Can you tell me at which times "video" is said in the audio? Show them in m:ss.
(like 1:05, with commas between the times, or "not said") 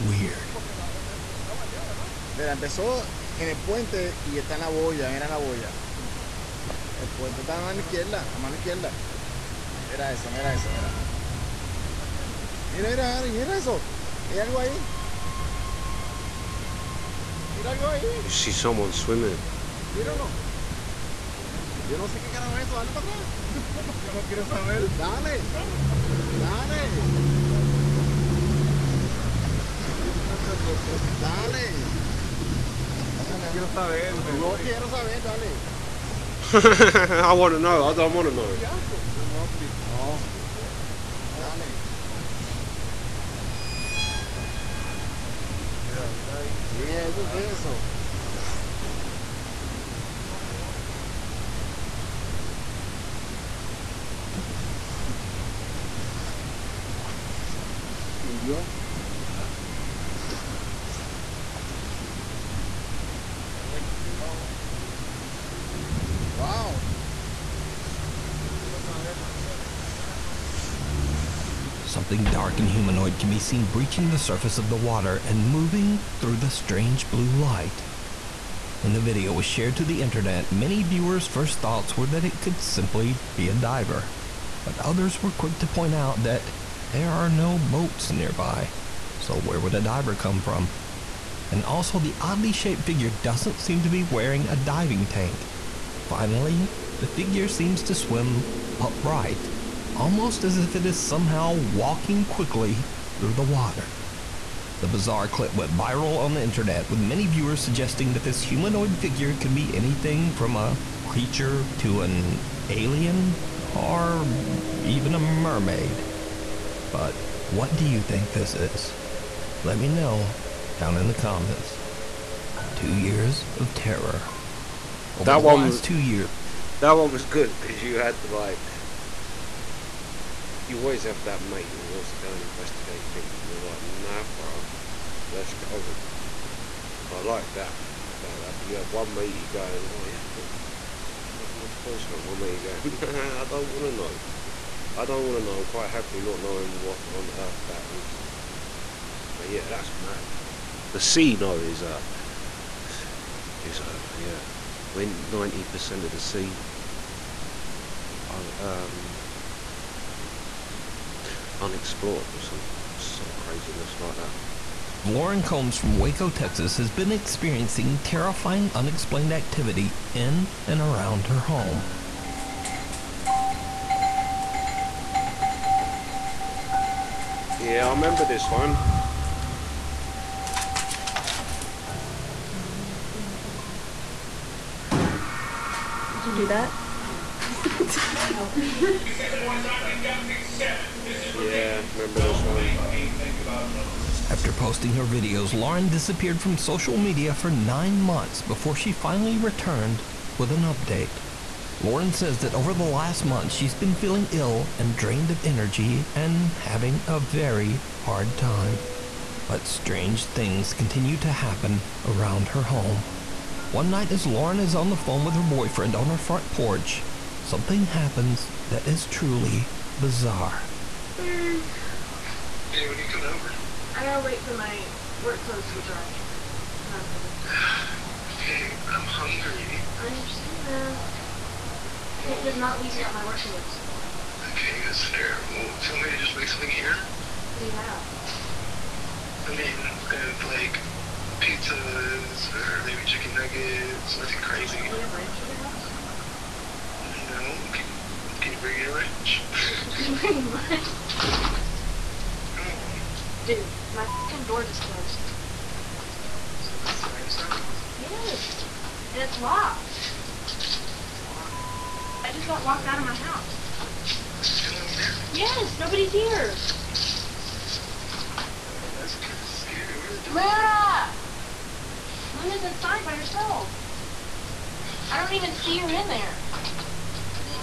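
1:19, 3:15.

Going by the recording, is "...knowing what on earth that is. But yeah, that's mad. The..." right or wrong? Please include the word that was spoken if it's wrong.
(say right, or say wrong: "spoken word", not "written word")
right.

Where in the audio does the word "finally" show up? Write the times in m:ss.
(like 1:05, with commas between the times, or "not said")
1:36, 3:18.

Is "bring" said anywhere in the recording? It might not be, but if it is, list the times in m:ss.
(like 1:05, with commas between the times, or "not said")
4:08.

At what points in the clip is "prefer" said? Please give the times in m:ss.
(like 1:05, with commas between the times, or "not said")
not said.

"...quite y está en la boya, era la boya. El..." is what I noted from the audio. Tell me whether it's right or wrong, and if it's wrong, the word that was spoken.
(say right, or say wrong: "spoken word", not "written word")
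wrong: "puente", not "quite".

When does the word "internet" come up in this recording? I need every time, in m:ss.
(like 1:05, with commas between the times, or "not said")
1:19, 1:46.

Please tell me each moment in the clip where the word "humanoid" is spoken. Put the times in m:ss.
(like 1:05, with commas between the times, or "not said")
1:12, 1:48.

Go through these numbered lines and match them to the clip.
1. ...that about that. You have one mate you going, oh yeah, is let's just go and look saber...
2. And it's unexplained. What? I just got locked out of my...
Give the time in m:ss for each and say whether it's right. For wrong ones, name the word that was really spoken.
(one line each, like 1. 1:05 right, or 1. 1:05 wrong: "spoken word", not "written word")
1. 2:17 wrong: "closer", not "saber"
2. 4:19 wrong: "locked", not "unexplained".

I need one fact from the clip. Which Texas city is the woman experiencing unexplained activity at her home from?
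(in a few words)
Waco.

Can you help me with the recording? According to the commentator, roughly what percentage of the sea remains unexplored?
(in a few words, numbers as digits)
90 percent.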